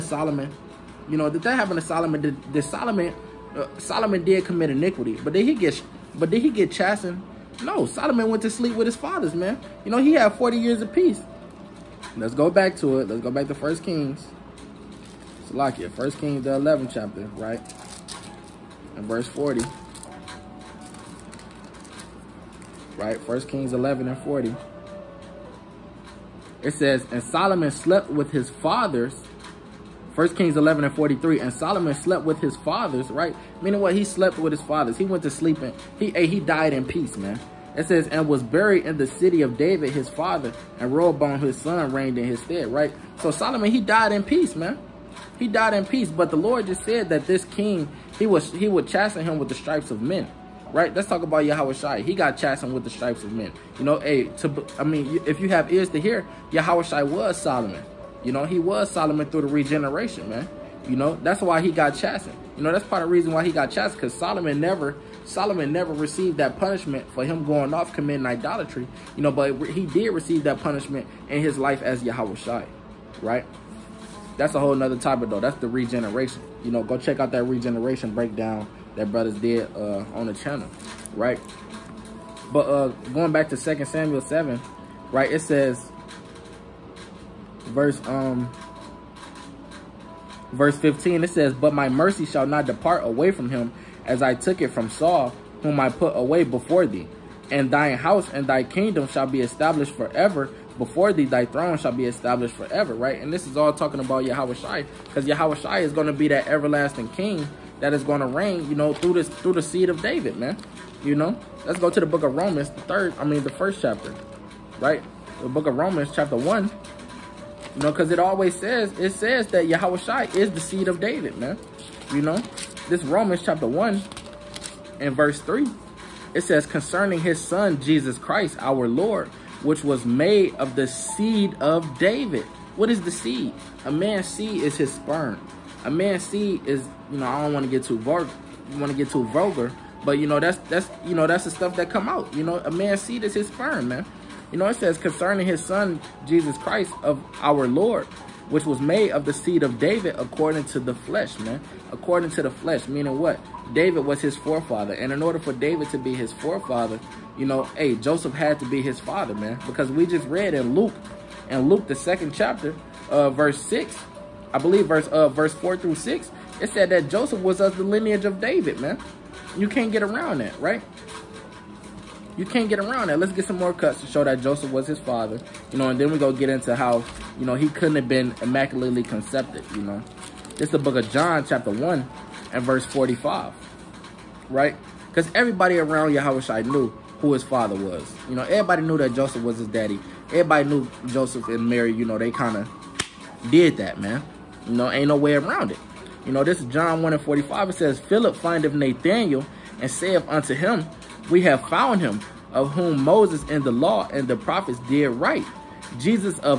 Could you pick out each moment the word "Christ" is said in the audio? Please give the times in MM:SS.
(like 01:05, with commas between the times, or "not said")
02:08, 02:26.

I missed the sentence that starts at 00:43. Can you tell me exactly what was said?
So Solomon, he died in peace, man.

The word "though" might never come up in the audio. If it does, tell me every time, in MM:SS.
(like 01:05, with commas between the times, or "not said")
01:15.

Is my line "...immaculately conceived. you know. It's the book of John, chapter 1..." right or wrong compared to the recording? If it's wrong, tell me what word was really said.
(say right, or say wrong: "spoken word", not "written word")
right.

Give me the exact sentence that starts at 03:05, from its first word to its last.
Because everybody around Yahushua knew who his father was.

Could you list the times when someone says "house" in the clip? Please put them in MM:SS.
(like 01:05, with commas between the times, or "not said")
01:37.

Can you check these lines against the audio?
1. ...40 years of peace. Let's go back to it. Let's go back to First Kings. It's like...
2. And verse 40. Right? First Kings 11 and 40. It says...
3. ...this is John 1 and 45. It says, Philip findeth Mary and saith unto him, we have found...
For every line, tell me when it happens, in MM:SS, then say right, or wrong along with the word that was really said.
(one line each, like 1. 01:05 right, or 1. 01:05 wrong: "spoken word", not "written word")
1. 00:10 right
2. 00:18 right
3. 03:16 wrong: "Nathanael", not "Mary".